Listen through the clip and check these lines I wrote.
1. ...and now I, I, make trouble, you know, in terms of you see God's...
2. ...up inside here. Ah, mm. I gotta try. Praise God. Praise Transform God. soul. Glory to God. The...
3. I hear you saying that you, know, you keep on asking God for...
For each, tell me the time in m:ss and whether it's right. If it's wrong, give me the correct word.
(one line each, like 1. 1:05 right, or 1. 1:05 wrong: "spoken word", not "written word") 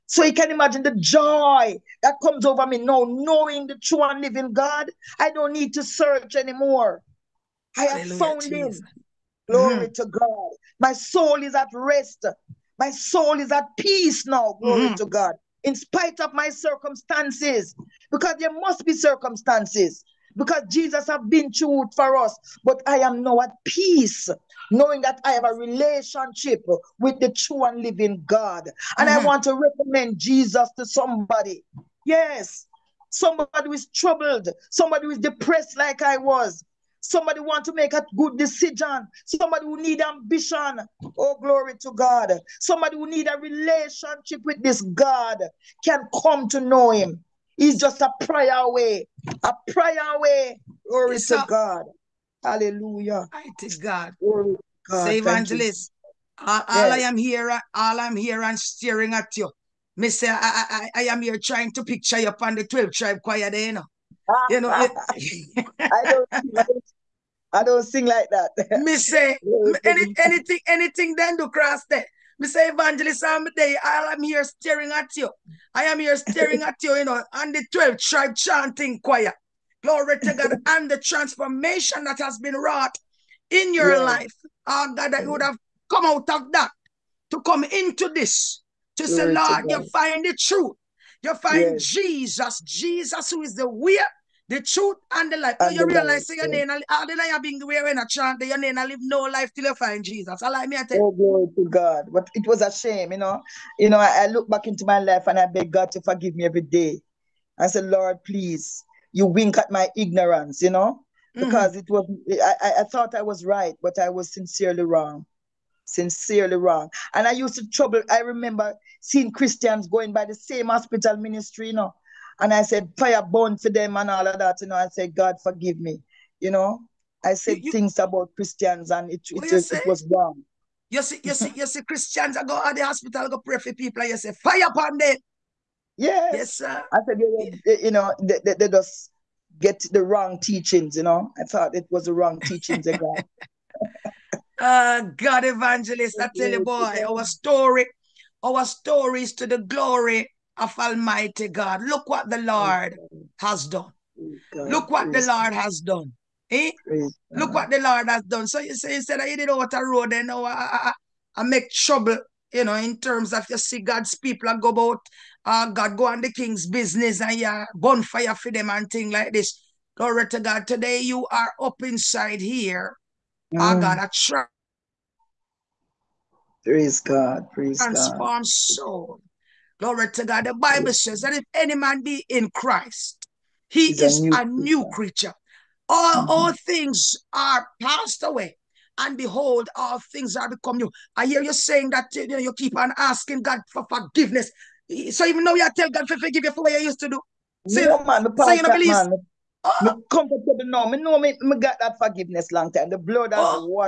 1. 2:40 right
2. 2:51 right
3. 3:11 right.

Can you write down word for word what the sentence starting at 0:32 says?
Yes, somebody who is troubled, somebody who is depressed like I was, Somebody want to make a good decision.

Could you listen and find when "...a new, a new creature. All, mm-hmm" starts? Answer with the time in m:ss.
3:04.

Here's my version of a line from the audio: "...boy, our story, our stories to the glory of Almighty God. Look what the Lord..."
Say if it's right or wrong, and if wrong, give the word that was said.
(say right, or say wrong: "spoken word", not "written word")
right.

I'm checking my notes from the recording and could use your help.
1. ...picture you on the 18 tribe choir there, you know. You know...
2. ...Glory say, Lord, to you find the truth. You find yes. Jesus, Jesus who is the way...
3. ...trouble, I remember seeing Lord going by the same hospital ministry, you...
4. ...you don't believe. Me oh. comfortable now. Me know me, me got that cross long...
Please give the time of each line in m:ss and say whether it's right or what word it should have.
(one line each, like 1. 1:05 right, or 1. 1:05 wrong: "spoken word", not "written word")
1. 1:01 wrong: "12", not "18"
2. 1:29 right
3. 1:57 wrong: "Christians", not "Lord"
4. 3:18 wrong: "forgiveness", not "cross".